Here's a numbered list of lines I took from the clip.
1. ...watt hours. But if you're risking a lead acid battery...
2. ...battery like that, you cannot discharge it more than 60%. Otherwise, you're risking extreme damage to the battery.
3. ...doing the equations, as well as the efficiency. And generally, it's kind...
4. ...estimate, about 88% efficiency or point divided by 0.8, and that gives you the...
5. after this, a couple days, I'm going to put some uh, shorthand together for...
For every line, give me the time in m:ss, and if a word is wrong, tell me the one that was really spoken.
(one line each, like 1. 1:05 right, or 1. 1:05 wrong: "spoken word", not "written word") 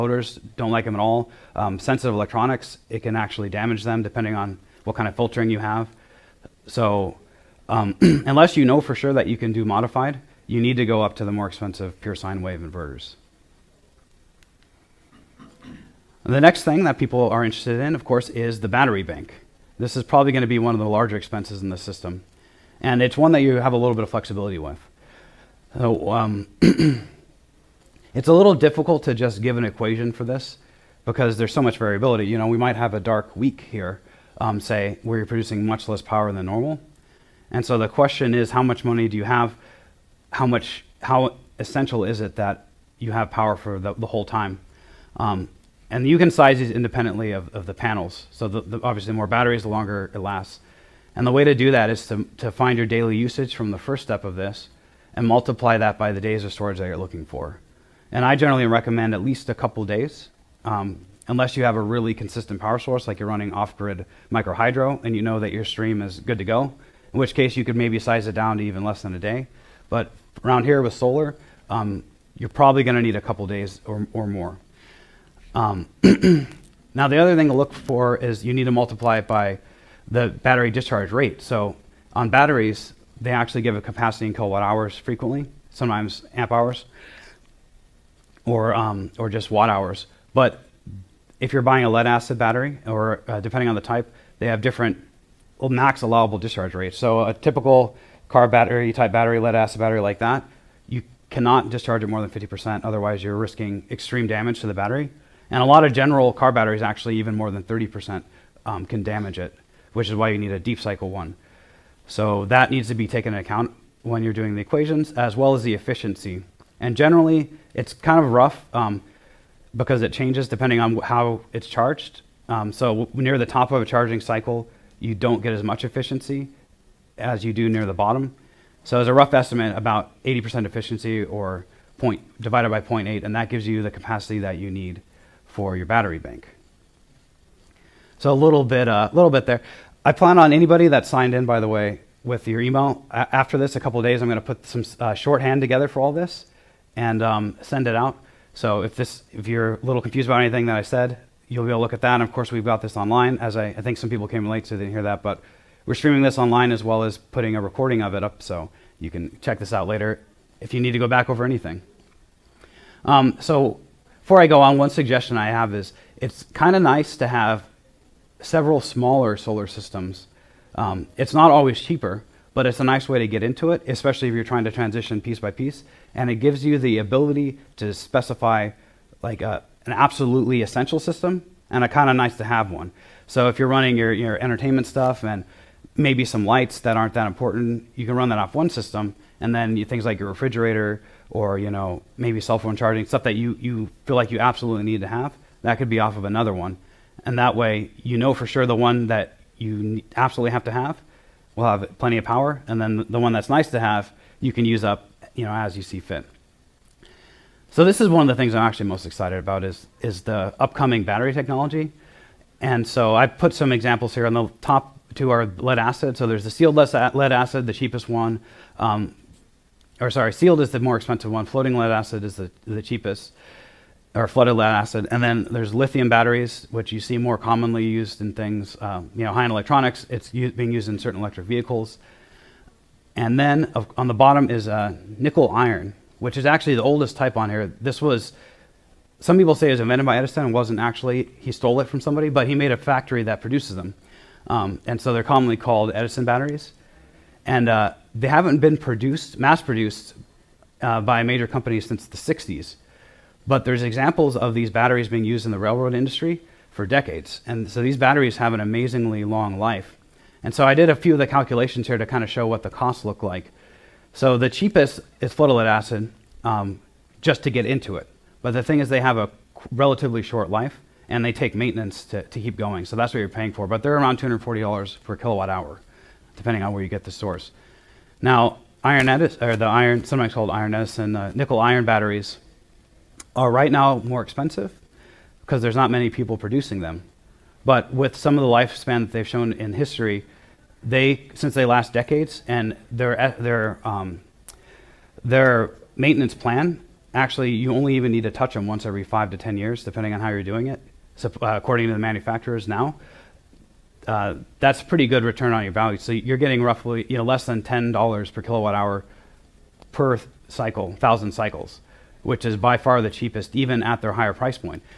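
1. 1:29 wrong: "buying", not "risking"
2. 1:39 wrong: "50", not "60"
3. 1:54 right
4. 2:09 wrong: "80", not "88"
5. 2:23 right.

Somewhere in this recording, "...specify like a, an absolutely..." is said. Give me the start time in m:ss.
2:57.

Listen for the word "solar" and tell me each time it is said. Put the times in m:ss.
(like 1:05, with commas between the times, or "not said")
1:10, 2:49.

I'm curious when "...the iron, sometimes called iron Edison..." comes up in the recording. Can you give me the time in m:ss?
4:39.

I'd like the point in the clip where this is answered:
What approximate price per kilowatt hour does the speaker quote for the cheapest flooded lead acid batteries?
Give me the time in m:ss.
4:34.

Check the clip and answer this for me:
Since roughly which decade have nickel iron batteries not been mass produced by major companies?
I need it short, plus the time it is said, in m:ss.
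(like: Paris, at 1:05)
the 60s, at 4:12.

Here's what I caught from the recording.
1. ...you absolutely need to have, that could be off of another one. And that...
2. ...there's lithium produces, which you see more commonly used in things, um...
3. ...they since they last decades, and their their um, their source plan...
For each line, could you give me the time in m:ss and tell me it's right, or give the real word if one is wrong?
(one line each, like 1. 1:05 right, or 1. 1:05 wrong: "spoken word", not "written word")
1. 3:14 right
2. 3:45 wrong: "batteries", not "produces"
3. 4:50 wrong: "maintenance", not "source".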